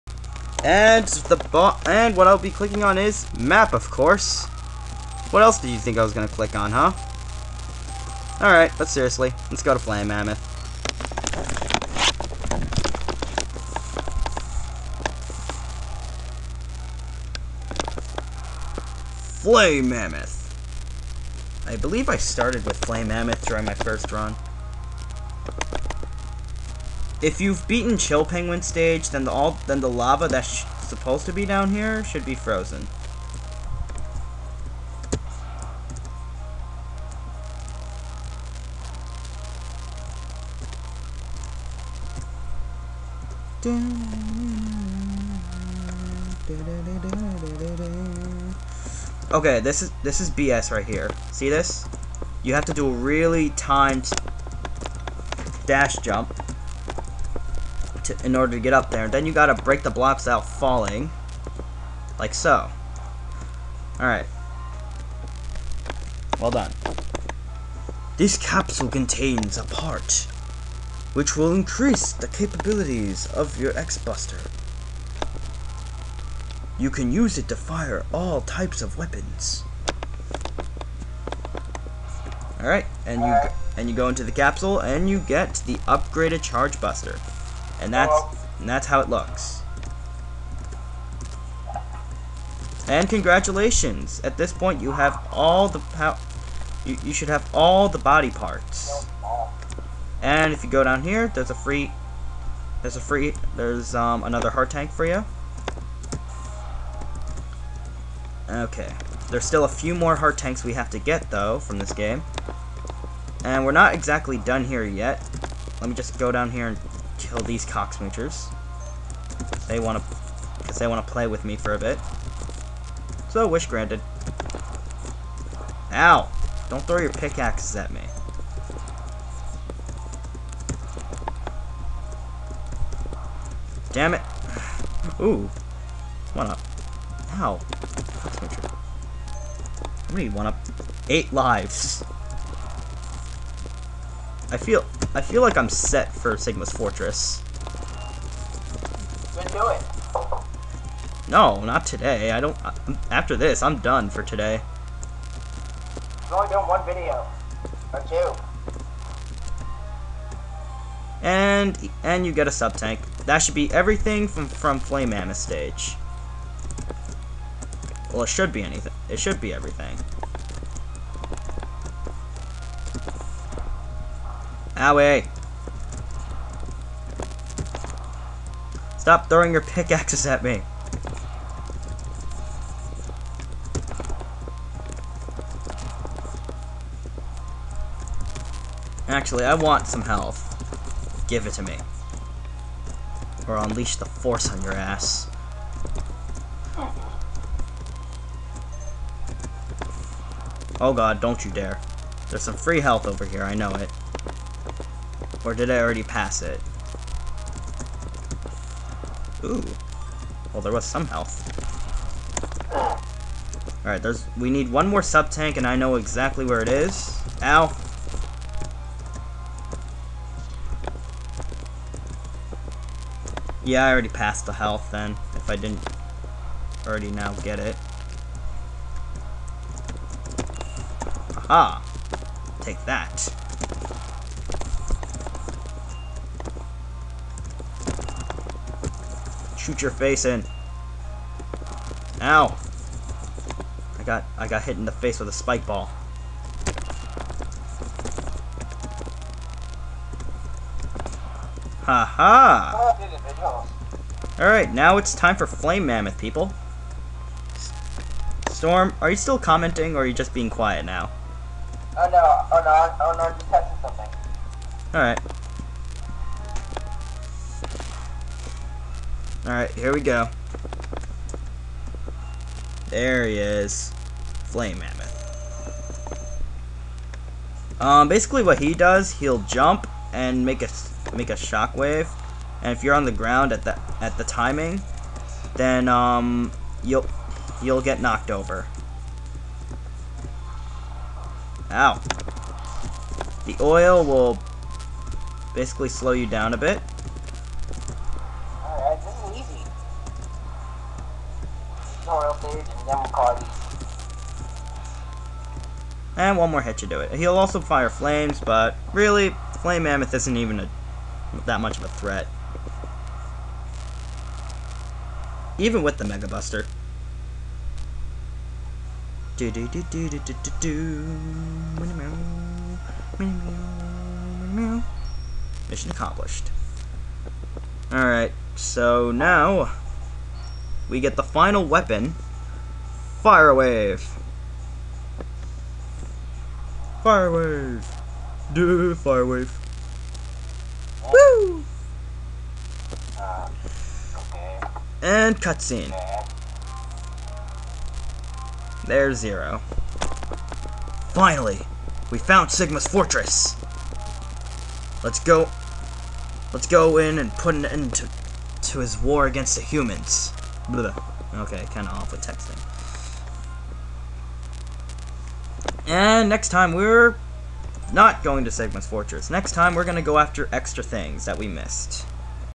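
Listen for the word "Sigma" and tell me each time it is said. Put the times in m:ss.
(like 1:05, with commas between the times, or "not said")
2:26, 5:52, 6:08.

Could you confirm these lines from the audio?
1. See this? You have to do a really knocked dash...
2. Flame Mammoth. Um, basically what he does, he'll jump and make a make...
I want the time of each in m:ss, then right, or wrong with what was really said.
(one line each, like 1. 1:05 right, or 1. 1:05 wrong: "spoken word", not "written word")
1. 0:51 wrong: "timed", not "knocked"
2. 4:34 right.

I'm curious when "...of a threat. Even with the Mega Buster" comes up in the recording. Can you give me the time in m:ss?
5:11.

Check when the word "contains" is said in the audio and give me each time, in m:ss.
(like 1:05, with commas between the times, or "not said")
1:08.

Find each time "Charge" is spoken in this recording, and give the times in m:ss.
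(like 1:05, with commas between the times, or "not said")
1:26.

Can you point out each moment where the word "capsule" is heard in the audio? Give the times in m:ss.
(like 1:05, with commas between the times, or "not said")
1:08, 1:24.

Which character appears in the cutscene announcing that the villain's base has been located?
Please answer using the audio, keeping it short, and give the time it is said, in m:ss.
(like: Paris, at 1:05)
Zero, at 5:49.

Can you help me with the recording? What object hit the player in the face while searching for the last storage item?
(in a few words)
A spike ball.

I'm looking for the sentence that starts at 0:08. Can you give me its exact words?
Alright, but seriously, let's go to Flame Mammoth.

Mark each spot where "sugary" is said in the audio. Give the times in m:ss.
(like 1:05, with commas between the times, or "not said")
not said.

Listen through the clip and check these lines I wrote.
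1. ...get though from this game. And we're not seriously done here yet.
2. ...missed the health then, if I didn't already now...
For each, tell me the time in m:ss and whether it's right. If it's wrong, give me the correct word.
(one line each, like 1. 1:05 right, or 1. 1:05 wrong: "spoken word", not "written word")
1. 1:50 wrong: "exactly", not "seriously"
2. 3:44 wrong: "passed", not "missed".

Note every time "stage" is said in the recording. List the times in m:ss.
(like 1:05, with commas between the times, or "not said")
0:28, 2:45.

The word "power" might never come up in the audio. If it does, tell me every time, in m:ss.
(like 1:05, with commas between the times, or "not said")
1:35.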